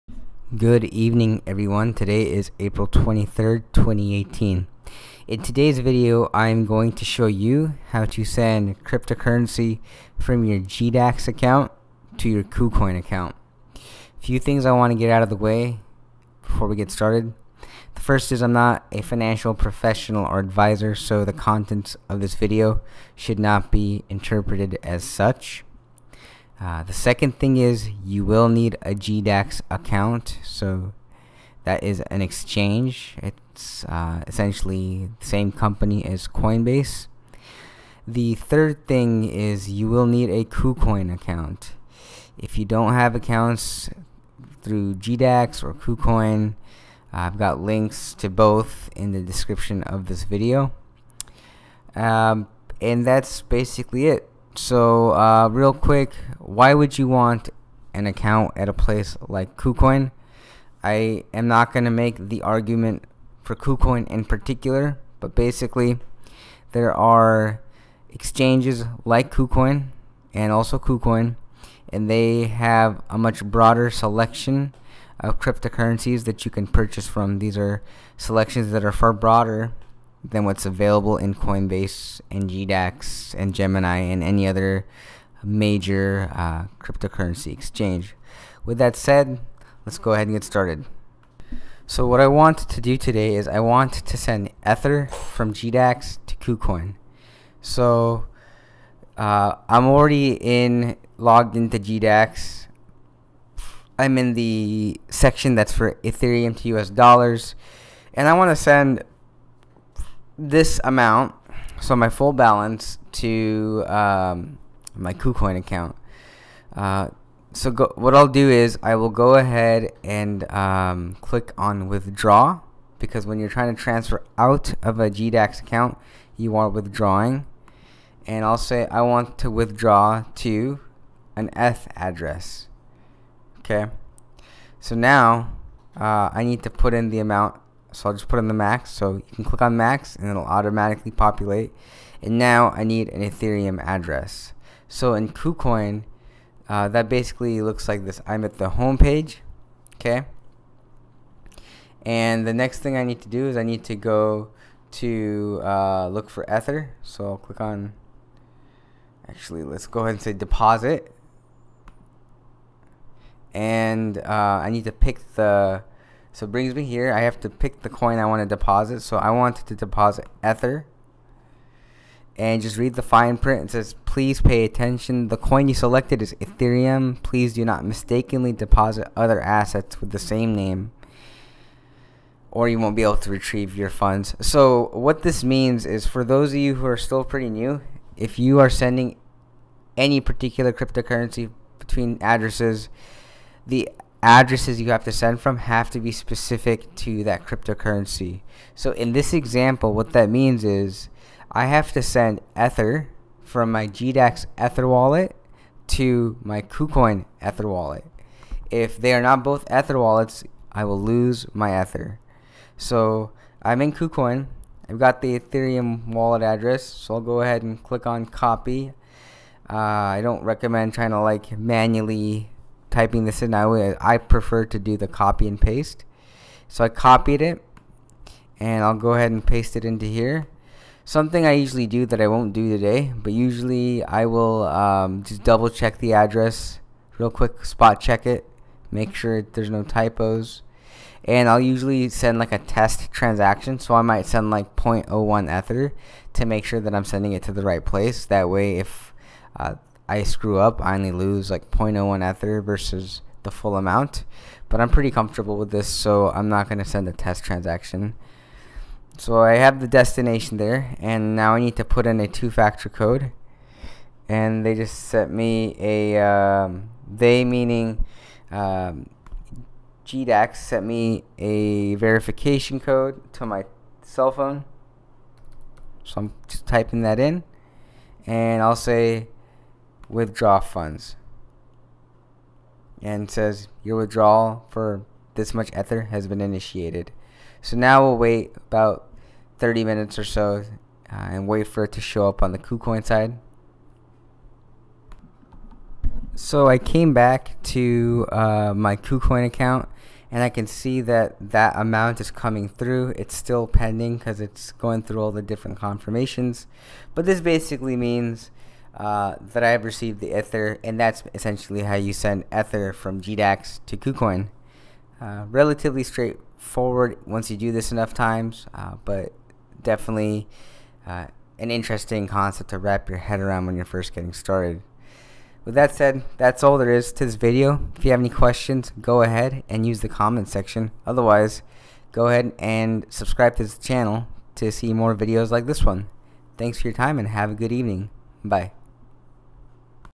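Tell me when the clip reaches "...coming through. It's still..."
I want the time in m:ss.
5:02.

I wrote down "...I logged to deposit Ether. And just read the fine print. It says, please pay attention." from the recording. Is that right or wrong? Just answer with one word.
wrong.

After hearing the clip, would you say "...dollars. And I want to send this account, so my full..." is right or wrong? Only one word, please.
wrong.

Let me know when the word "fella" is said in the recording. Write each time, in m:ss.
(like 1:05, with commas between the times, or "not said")
not said.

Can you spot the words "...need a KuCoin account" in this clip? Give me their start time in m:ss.
0:40.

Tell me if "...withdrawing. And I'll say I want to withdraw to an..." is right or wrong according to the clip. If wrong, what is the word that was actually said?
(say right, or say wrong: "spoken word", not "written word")
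right.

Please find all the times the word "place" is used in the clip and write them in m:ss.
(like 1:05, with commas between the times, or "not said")
0:58, 4:07.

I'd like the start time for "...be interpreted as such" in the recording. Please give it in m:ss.
0:23.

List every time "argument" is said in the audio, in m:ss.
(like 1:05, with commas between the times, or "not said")
1:02.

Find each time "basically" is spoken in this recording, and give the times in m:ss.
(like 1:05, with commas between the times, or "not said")
0:53, 1:05, 2:27, 5:07.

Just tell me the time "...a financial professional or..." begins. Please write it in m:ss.
0:18.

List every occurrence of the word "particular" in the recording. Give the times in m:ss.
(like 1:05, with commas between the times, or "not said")
1:04, 3:10.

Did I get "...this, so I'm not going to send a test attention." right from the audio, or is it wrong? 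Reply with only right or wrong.
wrong.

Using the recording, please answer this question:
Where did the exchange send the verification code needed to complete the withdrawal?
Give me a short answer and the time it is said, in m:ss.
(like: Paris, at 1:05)
cell phone, at 4:34.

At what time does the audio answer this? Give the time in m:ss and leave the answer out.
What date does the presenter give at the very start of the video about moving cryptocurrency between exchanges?
0:02.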